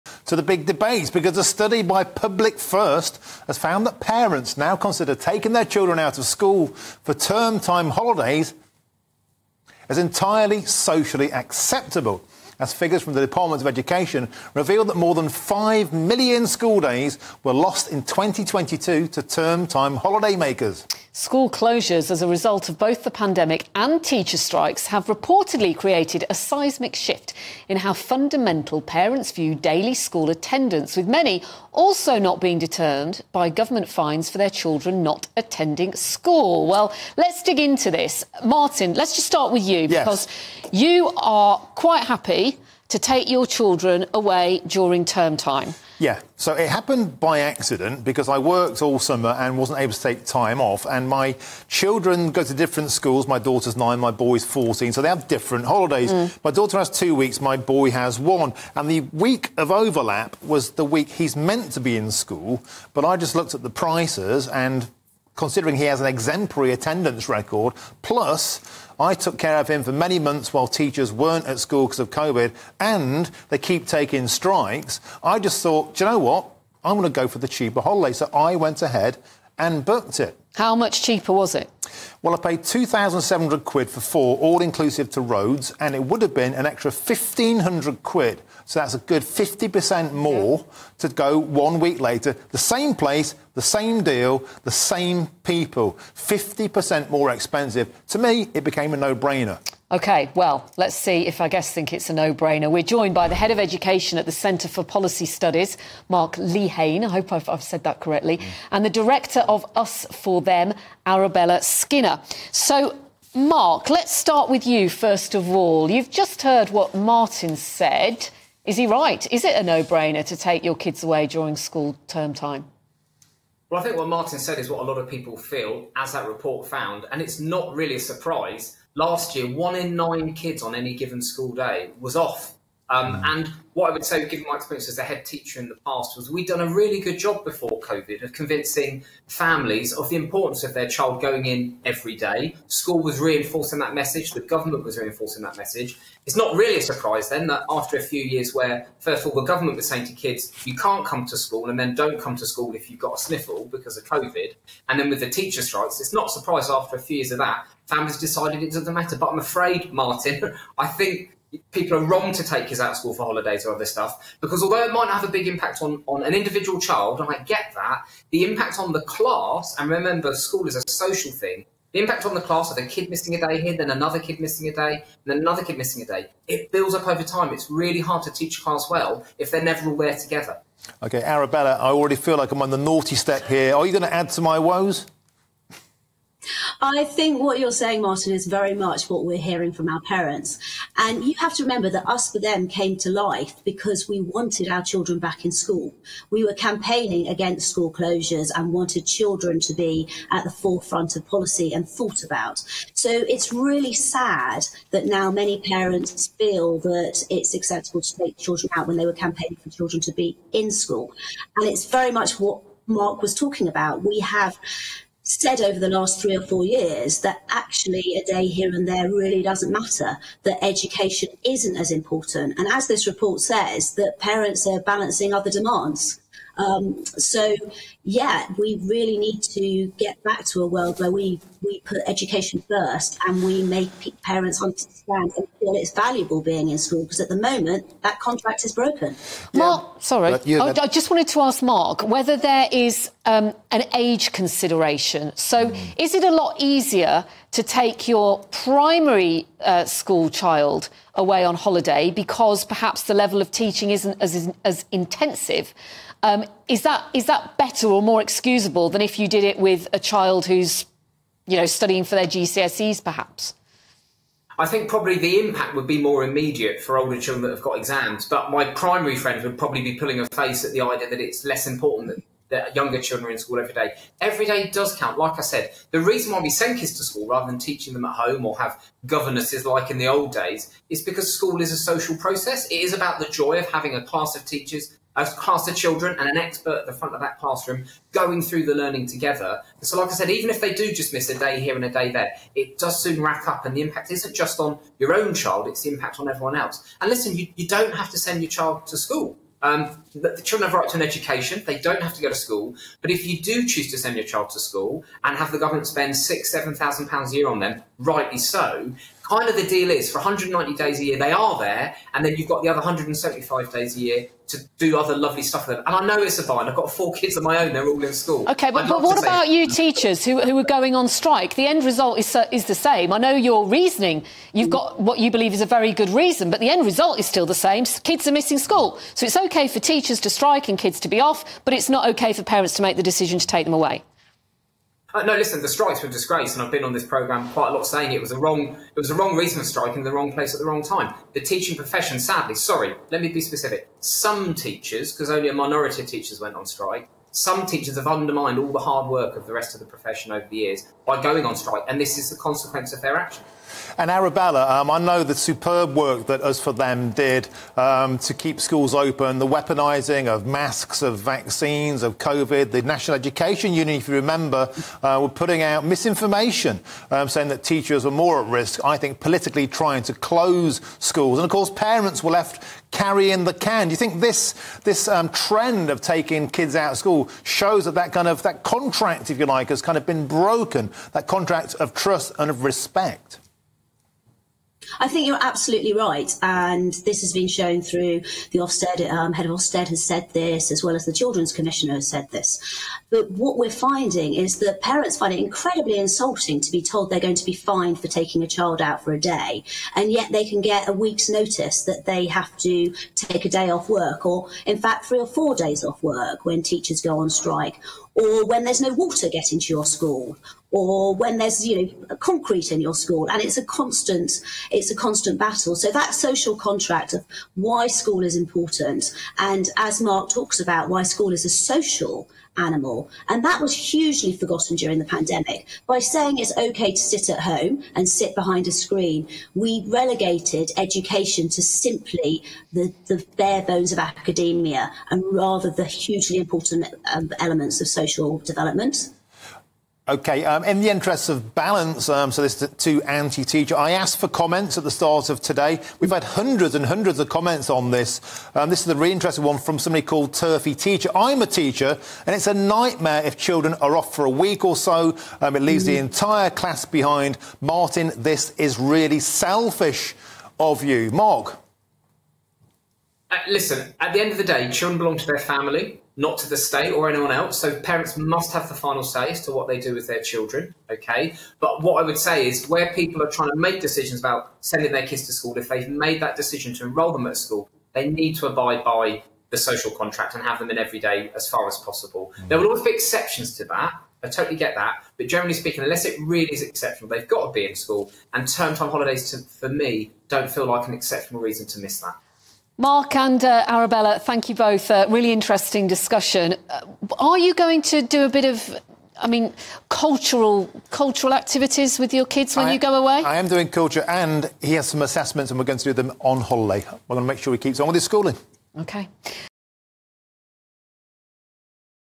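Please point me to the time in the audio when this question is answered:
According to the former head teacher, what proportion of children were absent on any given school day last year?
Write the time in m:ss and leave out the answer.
2:09.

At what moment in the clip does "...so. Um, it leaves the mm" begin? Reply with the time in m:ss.
7:34.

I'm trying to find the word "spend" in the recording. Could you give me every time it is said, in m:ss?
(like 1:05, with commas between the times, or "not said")
5:05.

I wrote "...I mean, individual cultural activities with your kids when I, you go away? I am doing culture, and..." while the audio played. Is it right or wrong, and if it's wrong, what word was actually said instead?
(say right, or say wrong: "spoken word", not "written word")
wrong: "cultural", not "individual".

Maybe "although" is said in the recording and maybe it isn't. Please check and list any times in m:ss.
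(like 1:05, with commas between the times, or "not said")
2:44.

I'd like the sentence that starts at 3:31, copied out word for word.
And it's very much what Mark was talking about.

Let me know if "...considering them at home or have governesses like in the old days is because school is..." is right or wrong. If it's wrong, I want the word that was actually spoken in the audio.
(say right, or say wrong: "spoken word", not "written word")
wrong: "teaching", not "considering".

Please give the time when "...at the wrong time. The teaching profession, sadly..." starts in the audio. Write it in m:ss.
5:40.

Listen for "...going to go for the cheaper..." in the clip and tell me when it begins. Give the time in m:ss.
1:16.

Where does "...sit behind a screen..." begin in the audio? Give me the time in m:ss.
7:08.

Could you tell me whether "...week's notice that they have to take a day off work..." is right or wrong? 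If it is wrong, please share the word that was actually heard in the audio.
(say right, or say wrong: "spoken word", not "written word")
right.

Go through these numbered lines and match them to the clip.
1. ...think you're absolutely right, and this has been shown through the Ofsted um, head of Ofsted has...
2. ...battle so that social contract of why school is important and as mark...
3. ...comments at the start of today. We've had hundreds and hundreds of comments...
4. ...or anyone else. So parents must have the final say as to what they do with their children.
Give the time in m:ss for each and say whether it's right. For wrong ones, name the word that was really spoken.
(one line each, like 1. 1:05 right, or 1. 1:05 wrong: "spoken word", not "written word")
1. 6:25 right
2. 6:55 right
3. 7:24 right
4. 7:46 right.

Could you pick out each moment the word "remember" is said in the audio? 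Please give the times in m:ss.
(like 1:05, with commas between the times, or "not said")
2:49, 3:11, 6:04.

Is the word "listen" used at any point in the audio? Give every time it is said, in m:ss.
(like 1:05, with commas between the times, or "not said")
4:57, 5:35, 7:43.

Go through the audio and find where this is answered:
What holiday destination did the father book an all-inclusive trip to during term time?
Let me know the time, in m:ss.
1:25.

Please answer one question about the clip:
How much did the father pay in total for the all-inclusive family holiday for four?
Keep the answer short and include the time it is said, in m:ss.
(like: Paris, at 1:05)
£2,700, at 1:22.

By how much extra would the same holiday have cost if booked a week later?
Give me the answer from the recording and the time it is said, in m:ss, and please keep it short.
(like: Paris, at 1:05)
£1,500, at 1:26.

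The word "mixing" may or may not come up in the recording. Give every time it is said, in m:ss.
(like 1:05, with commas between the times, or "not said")
not said.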